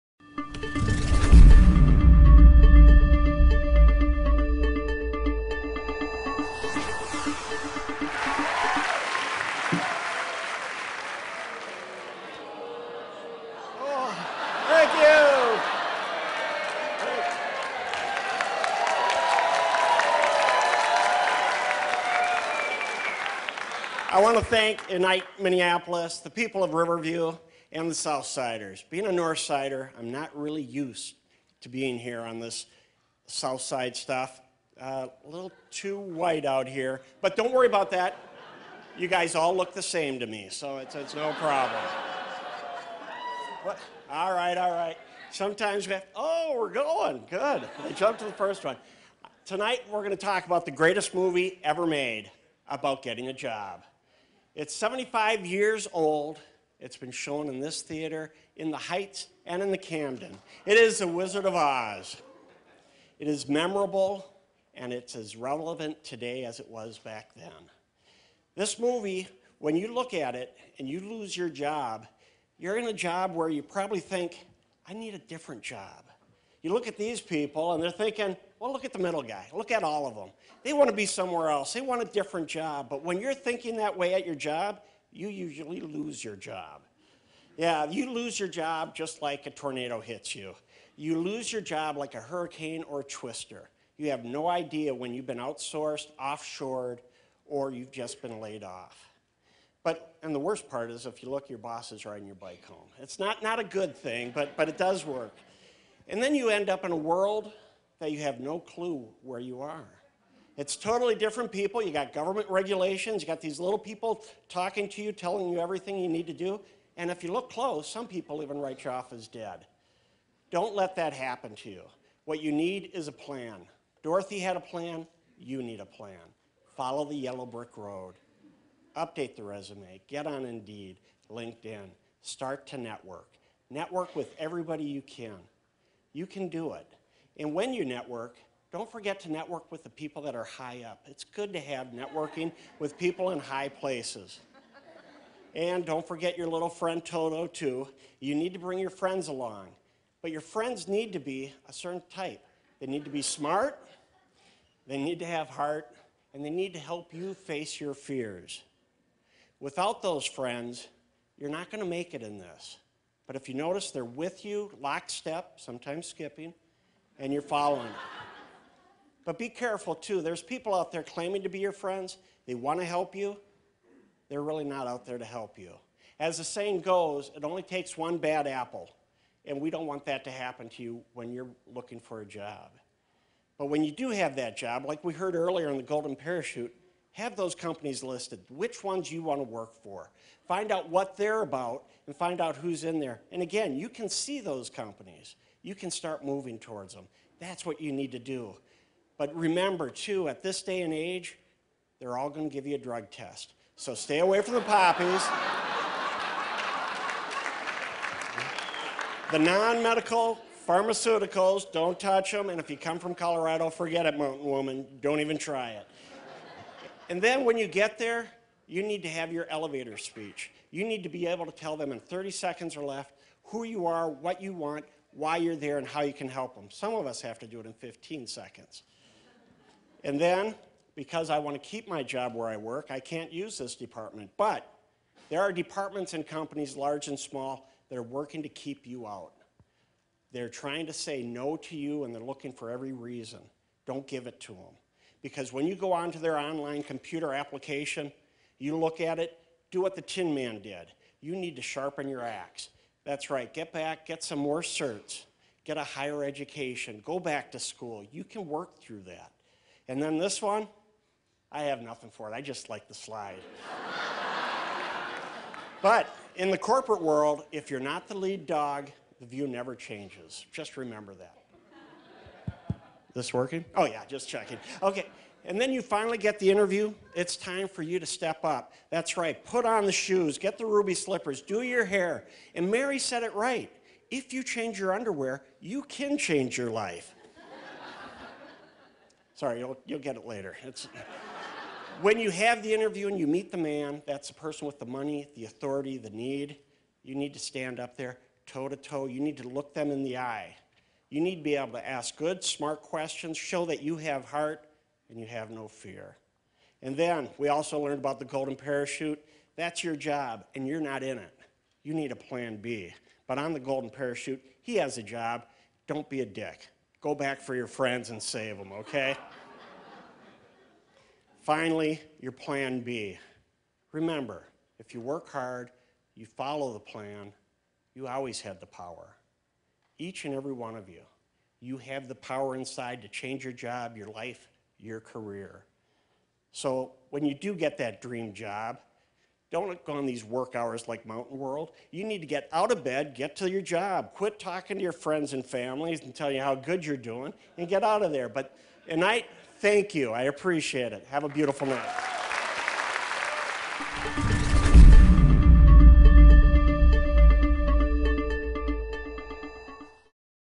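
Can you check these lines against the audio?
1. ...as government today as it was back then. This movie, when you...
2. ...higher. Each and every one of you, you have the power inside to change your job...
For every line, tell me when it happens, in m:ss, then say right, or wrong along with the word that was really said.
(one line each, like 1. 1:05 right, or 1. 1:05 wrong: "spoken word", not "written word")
1. 1:05 wrong: "relevant", not "government"
2. 5:28 wrong: "power", not "higher".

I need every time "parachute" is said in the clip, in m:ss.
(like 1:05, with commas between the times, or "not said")
3:06, 5:08, 5:13.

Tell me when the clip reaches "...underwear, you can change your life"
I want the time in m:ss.
4:44.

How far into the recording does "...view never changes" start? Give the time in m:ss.
4:29.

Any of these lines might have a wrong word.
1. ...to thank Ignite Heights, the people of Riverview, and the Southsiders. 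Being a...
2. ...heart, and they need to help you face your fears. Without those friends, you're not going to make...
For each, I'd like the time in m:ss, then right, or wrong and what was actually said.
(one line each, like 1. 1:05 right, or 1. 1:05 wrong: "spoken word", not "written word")
1. 0:24 wrong: "Minneapolis", not "Heights"
2. 2:35 right.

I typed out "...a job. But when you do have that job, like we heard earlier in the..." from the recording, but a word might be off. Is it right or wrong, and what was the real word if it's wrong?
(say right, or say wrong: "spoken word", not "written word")
right.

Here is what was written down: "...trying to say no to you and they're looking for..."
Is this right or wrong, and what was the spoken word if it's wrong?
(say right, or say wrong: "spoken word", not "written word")
right.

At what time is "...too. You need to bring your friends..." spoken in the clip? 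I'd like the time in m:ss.
2:27.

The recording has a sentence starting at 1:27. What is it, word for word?
Yeah, you lose your job just like a tornado hits you.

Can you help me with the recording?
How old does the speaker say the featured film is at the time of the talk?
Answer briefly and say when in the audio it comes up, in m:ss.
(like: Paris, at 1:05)
75 years, at 0:54.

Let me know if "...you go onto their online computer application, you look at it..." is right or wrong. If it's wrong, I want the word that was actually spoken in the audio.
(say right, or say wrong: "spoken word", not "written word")
right.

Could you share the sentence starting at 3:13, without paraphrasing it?
And again, you can see those companies you can start moving towards them.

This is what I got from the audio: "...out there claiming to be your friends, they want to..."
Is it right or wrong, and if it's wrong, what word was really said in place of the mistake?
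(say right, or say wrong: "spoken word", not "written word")
right.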